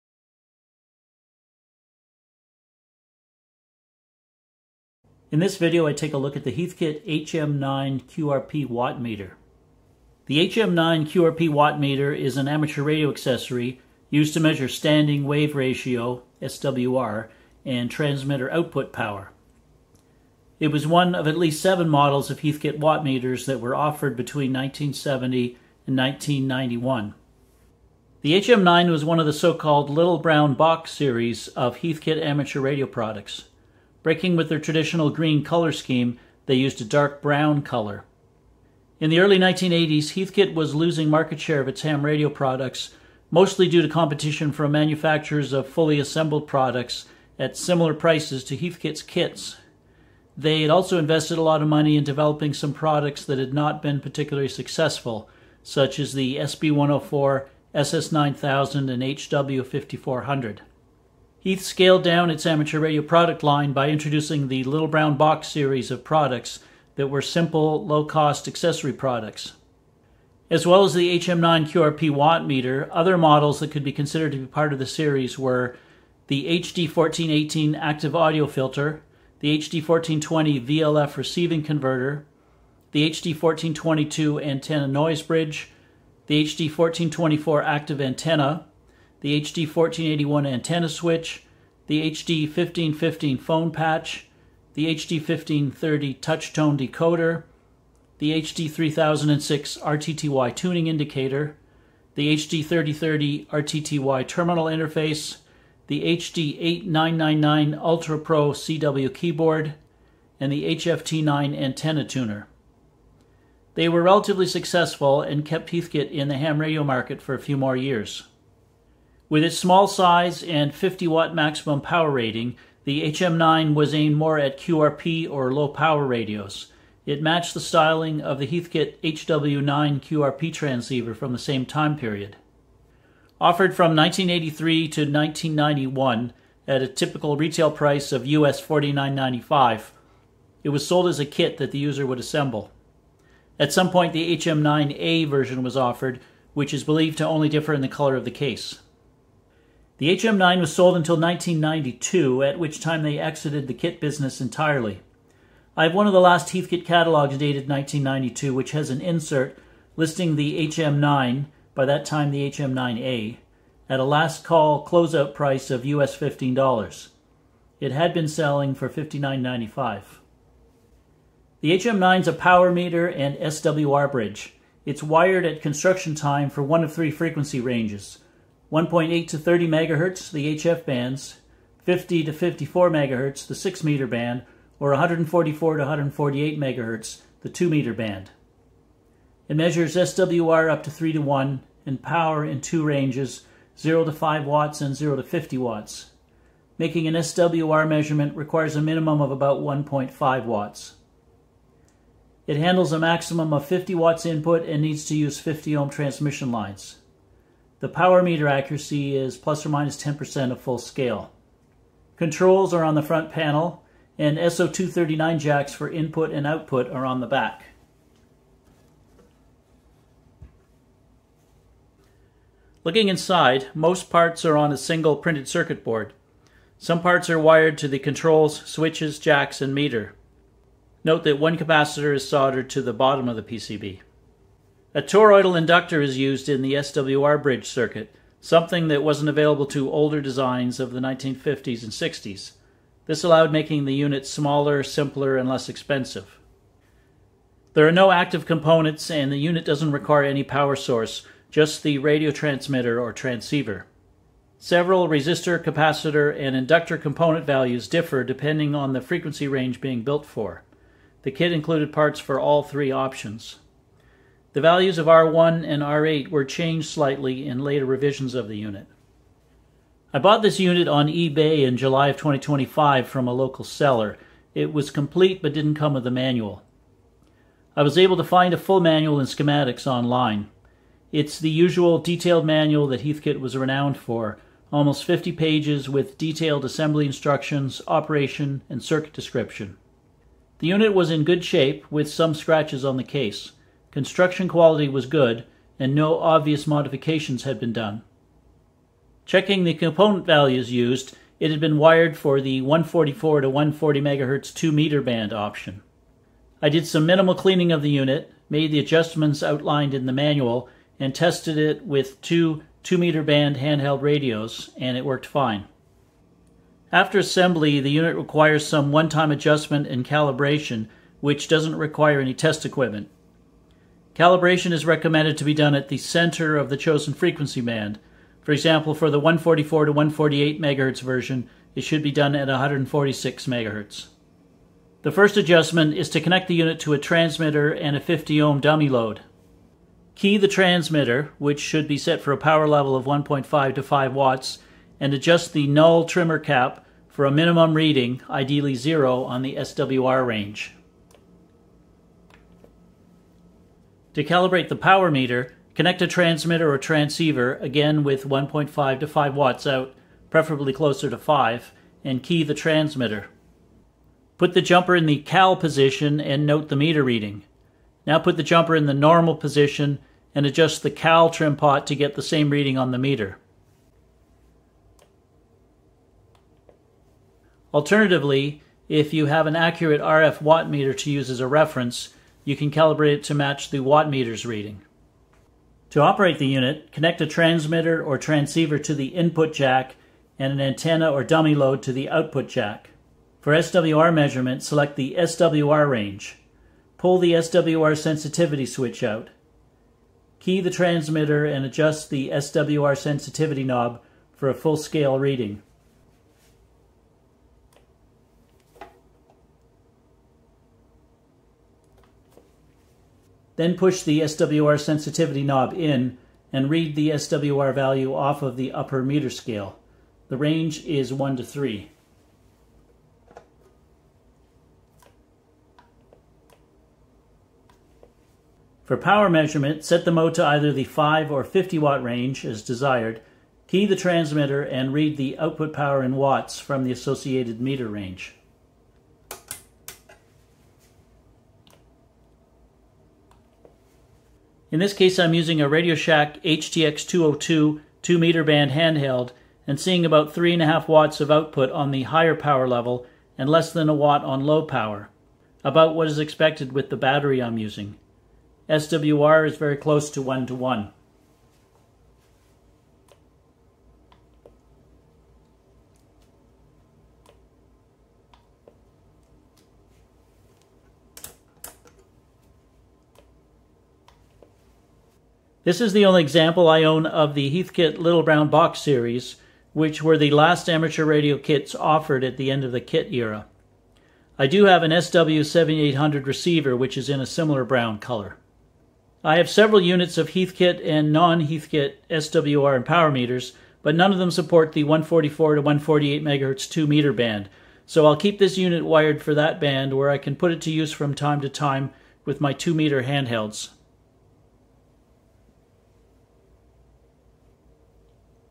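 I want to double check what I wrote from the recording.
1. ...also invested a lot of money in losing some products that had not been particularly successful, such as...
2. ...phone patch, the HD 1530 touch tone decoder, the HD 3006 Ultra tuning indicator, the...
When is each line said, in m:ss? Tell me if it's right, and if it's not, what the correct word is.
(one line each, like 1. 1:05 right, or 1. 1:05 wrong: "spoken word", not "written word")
1. 0:50 wrong: "developing", not "losing"
2. 1:33 wrong: "RTTY", not "Ultra".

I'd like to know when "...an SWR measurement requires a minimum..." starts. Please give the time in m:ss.
3:17.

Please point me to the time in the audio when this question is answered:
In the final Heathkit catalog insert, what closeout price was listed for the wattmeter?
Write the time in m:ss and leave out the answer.
2:45.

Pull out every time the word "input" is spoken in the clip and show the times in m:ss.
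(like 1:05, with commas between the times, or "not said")
3:24, 3:35, 6:29.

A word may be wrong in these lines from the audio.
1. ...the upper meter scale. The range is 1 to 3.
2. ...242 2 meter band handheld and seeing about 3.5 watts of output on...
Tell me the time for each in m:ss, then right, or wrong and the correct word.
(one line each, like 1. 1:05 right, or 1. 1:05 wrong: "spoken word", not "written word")
1. 6:58 right
2. 7:27 wrong: "202", not "242".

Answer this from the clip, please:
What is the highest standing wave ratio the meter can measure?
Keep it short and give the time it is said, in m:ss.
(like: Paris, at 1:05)
3 to 1, at 3:10.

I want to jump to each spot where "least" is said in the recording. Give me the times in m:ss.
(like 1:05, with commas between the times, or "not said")
0:21.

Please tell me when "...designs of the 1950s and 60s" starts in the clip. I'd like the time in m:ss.
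4:00.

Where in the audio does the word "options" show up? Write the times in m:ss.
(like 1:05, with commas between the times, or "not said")
4:22, 5:05.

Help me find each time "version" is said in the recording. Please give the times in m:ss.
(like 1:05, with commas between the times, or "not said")
2:25, 5:31.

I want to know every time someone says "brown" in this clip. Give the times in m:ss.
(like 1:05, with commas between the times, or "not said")
0:30, 0:37, 1:04, 7:58, 8:07.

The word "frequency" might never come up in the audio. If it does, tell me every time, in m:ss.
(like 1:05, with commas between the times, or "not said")
2:57, 4:18, 5:27.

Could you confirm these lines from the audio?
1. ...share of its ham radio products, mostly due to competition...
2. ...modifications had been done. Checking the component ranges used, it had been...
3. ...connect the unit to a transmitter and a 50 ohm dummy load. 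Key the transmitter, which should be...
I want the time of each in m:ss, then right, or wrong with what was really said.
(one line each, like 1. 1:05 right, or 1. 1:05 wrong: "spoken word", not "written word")
1. 0:41 right
2. 4:56 wrong: "values", not "ranges"
3. 5:36 right.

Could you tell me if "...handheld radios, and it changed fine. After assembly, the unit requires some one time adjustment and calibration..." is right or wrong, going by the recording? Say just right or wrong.
wrong.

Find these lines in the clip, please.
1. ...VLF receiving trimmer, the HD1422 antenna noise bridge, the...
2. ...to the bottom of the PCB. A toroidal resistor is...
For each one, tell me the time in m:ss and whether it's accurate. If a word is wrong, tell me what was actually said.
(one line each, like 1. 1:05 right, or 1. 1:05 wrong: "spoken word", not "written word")
1. 1:20 wrong: "converter", not "trimmer"
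2. 3:52 wrong: "inductor", not "resistor".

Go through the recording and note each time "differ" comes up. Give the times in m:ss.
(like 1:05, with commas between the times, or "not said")
2:27, 4:17.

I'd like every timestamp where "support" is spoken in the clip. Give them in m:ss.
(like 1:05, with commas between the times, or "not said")
8:14.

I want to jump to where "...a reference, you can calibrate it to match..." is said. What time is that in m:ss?
6:21.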